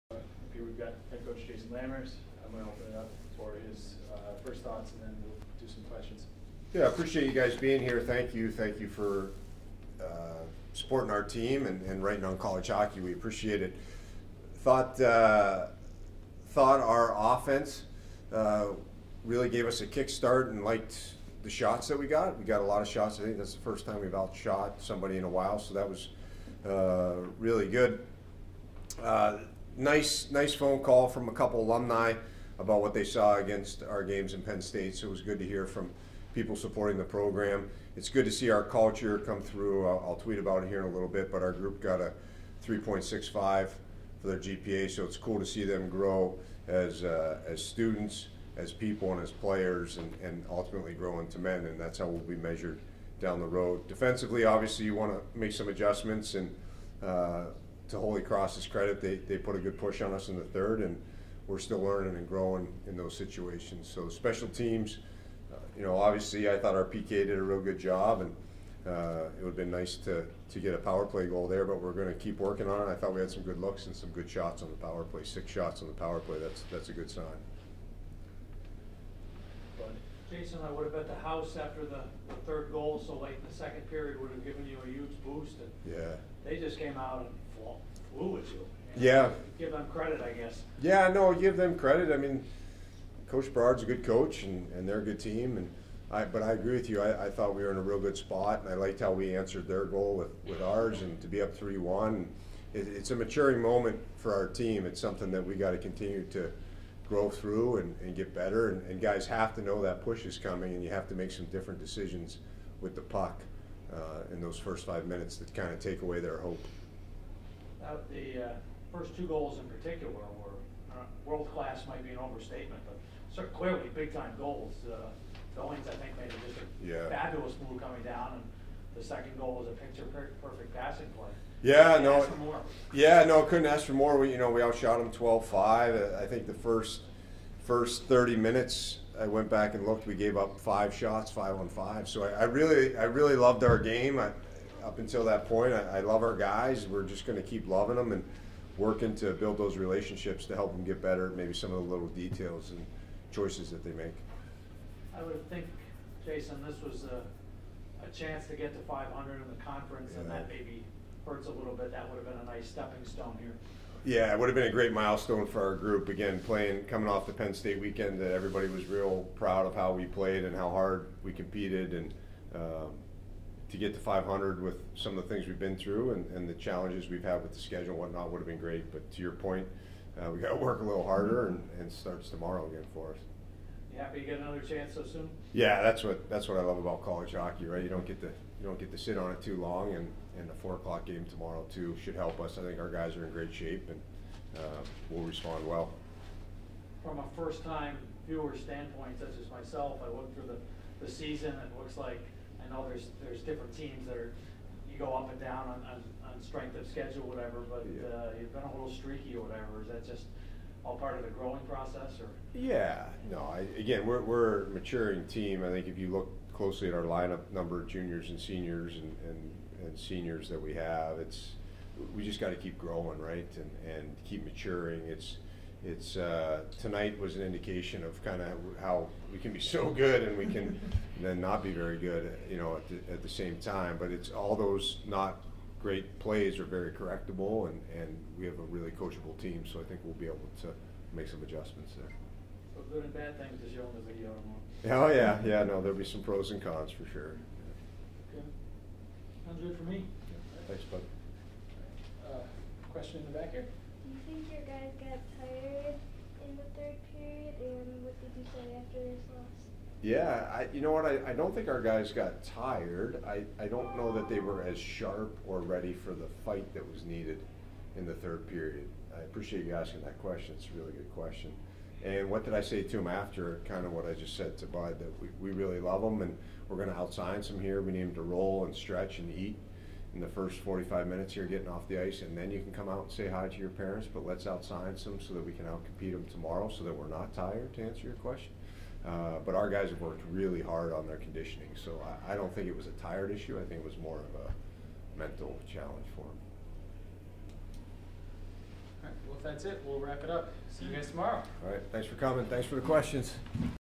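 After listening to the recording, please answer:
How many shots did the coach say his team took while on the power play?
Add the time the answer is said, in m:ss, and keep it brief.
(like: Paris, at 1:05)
6, at 1:15.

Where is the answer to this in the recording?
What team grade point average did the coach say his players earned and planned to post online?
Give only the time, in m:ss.
0:42.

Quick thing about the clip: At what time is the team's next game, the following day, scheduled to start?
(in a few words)
4 o'clock.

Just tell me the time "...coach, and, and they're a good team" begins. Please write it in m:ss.
1:34.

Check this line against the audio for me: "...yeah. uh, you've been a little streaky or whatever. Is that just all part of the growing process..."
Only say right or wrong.
right.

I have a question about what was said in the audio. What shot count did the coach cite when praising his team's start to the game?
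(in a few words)
12-5.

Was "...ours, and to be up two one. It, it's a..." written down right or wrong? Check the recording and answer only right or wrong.
wrong.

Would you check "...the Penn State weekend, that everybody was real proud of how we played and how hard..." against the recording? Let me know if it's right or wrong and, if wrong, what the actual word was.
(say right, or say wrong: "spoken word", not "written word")
right.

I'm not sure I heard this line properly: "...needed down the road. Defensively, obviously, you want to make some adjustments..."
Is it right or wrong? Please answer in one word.
wrong.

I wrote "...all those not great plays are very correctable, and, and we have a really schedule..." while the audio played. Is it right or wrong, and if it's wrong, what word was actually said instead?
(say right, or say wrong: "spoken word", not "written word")
wrong: "coachable", not "schedule".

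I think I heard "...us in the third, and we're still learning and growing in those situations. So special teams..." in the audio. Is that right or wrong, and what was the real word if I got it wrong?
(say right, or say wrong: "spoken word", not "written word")
right.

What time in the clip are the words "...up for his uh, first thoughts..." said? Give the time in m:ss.
0:02.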